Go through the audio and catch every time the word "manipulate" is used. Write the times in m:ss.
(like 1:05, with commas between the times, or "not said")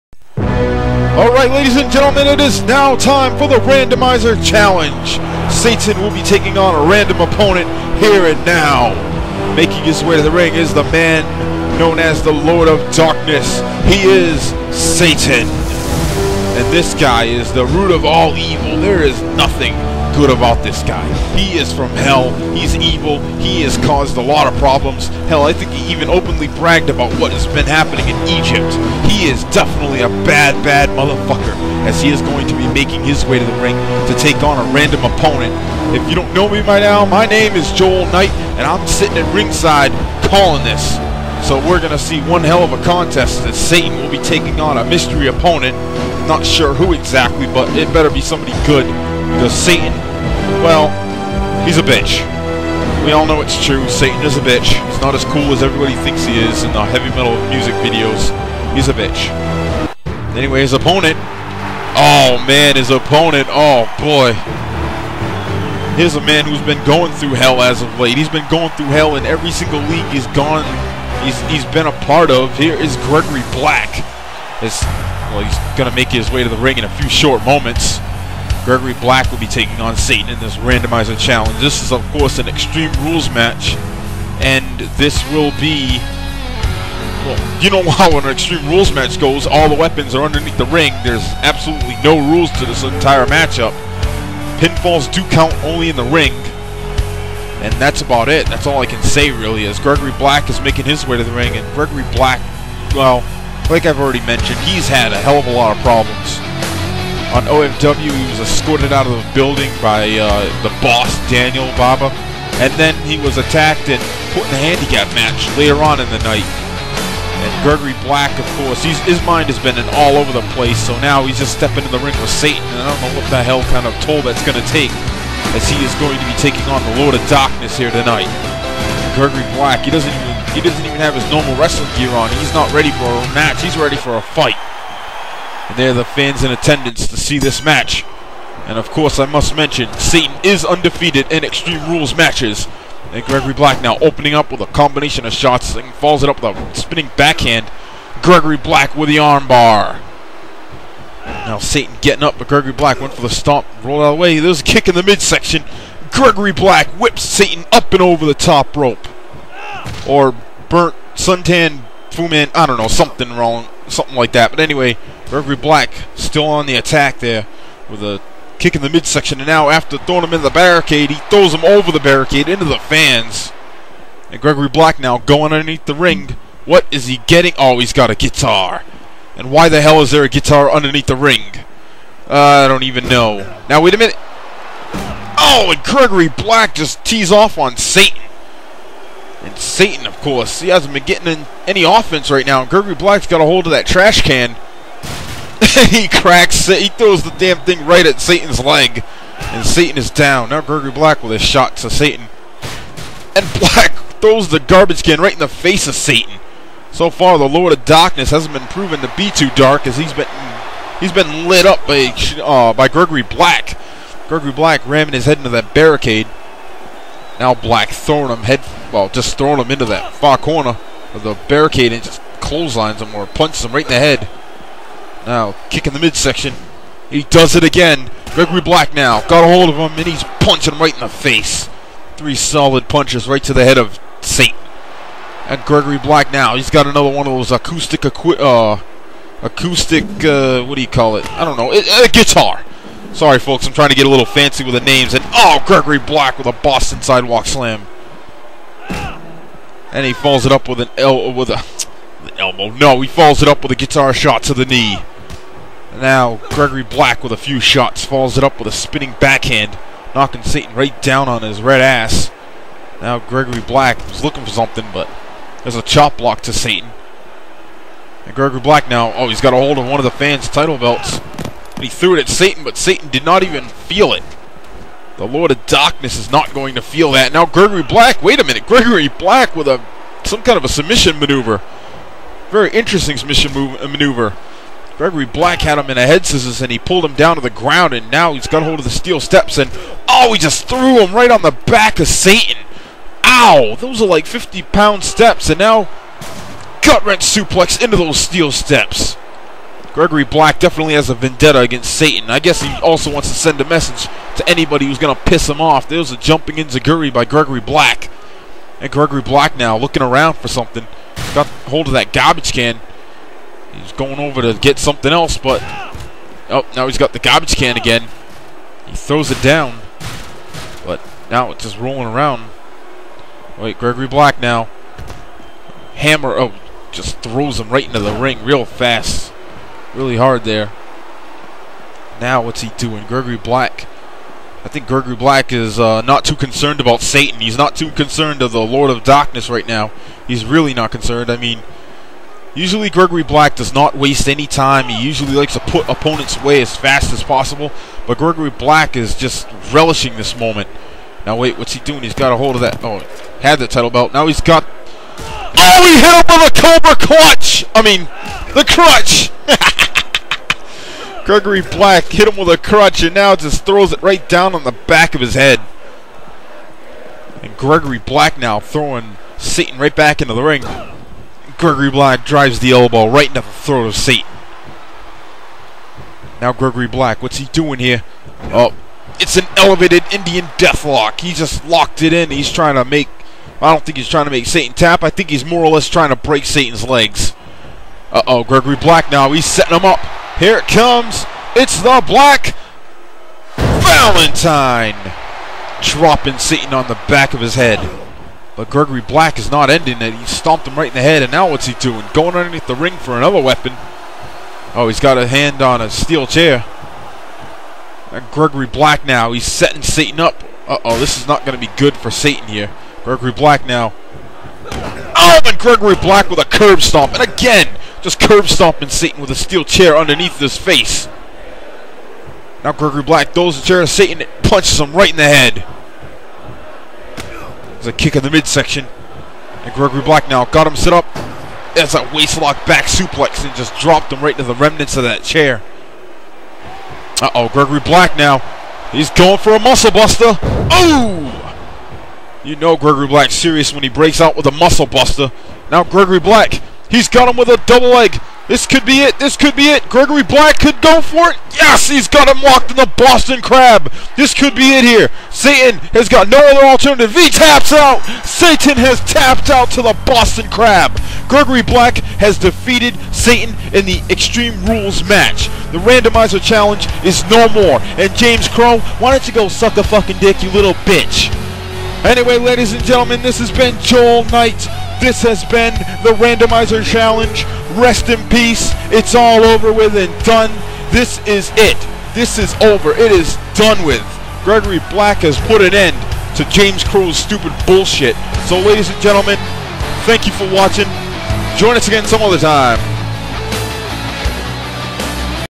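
not said.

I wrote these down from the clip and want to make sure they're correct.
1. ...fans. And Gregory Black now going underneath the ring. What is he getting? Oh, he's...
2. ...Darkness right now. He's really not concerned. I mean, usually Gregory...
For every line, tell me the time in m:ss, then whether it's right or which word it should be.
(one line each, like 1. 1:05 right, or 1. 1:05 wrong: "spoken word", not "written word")
1. 2:52 right
2. 5:39 right.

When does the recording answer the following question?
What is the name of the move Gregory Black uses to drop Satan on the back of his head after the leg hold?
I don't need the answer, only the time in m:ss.
6:31.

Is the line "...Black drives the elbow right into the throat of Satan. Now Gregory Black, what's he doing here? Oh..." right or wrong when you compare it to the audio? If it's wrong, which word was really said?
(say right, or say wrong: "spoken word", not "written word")
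right.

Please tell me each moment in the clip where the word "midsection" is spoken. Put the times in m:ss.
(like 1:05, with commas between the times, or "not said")
2:35, 2:48, 3:45, 7:08.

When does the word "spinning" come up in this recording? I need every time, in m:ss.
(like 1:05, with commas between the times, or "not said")
2:26, 4:18.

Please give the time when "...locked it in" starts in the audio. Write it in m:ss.
6:21.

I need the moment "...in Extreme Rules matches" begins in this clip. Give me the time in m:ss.
2:21.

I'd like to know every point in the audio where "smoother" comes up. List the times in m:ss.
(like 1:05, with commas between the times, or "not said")
not said.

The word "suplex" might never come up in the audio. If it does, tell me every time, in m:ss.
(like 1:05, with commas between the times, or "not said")
4:57, 7:12.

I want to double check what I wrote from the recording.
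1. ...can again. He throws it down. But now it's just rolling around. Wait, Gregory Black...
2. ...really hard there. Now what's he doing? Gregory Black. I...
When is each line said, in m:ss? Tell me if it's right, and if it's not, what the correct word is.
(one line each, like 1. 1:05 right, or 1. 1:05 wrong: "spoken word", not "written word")
1. 5:17 right
2. 5:29 right.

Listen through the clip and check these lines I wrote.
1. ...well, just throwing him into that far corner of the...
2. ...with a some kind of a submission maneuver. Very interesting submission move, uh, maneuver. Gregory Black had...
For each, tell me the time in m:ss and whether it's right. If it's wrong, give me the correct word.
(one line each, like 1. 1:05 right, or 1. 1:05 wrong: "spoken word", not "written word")
1. 3:38 right
2. 4:39 right.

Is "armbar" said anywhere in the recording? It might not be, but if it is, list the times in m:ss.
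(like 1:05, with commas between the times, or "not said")
2:29.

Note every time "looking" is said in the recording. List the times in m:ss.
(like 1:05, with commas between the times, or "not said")
4:24, 5:09.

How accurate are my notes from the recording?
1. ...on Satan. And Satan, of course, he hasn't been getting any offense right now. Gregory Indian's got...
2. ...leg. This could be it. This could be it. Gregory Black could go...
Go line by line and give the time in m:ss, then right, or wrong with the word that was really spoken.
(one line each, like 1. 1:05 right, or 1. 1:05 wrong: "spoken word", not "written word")
1. 3:07 wrong: "Black", not "Indian"
2. 7:27 right.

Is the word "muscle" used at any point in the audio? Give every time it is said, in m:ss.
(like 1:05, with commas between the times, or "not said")
7:19, 7:24.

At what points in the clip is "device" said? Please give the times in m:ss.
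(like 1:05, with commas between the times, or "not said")
not said.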